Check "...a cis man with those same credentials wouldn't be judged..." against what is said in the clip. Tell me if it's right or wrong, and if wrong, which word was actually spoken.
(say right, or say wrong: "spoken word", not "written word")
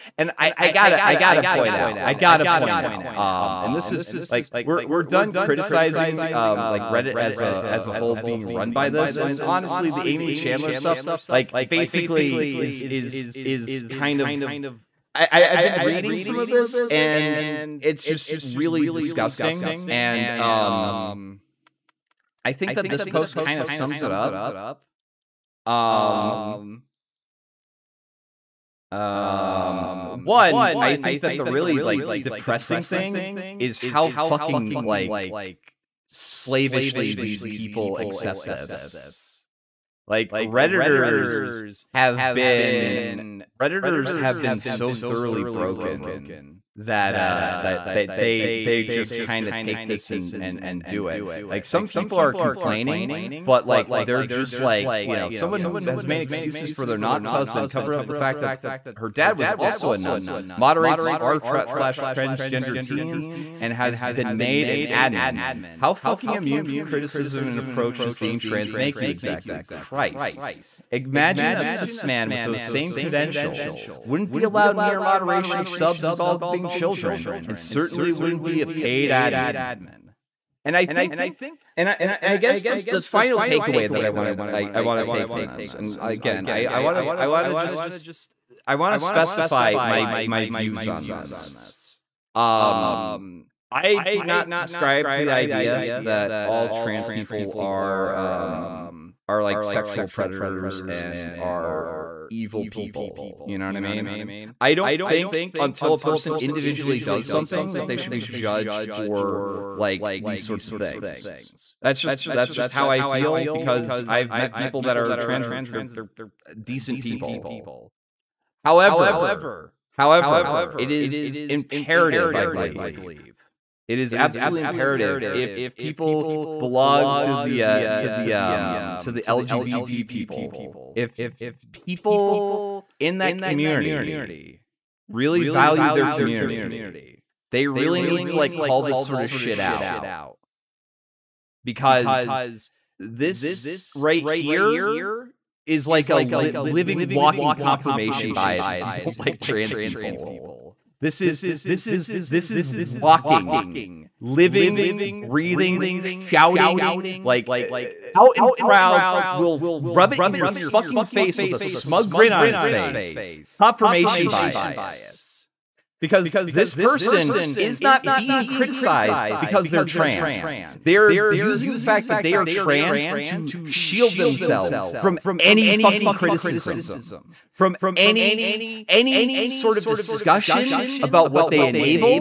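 wrong: "allowed", not "judged".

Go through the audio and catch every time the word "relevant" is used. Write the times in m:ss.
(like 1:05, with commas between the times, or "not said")
not said.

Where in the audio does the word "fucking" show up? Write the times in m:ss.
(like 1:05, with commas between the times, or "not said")
0:34, 1:05, 2:40, 2:55.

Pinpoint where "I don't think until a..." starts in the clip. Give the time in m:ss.
1:44.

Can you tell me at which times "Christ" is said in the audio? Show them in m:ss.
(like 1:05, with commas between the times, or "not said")
1:09.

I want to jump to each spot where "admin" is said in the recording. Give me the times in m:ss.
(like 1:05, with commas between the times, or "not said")
1:04, 1:19.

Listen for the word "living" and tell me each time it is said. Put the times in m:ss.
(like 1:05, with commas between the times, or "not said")
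2:26, 2:34.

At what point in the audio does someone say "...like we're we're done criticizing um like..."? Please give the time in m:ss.
0:04.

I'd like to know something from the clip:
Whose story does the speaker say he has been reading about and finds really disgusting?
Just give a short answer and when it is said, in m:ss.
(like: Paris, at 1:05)
Aimee Challenor, at 0:10.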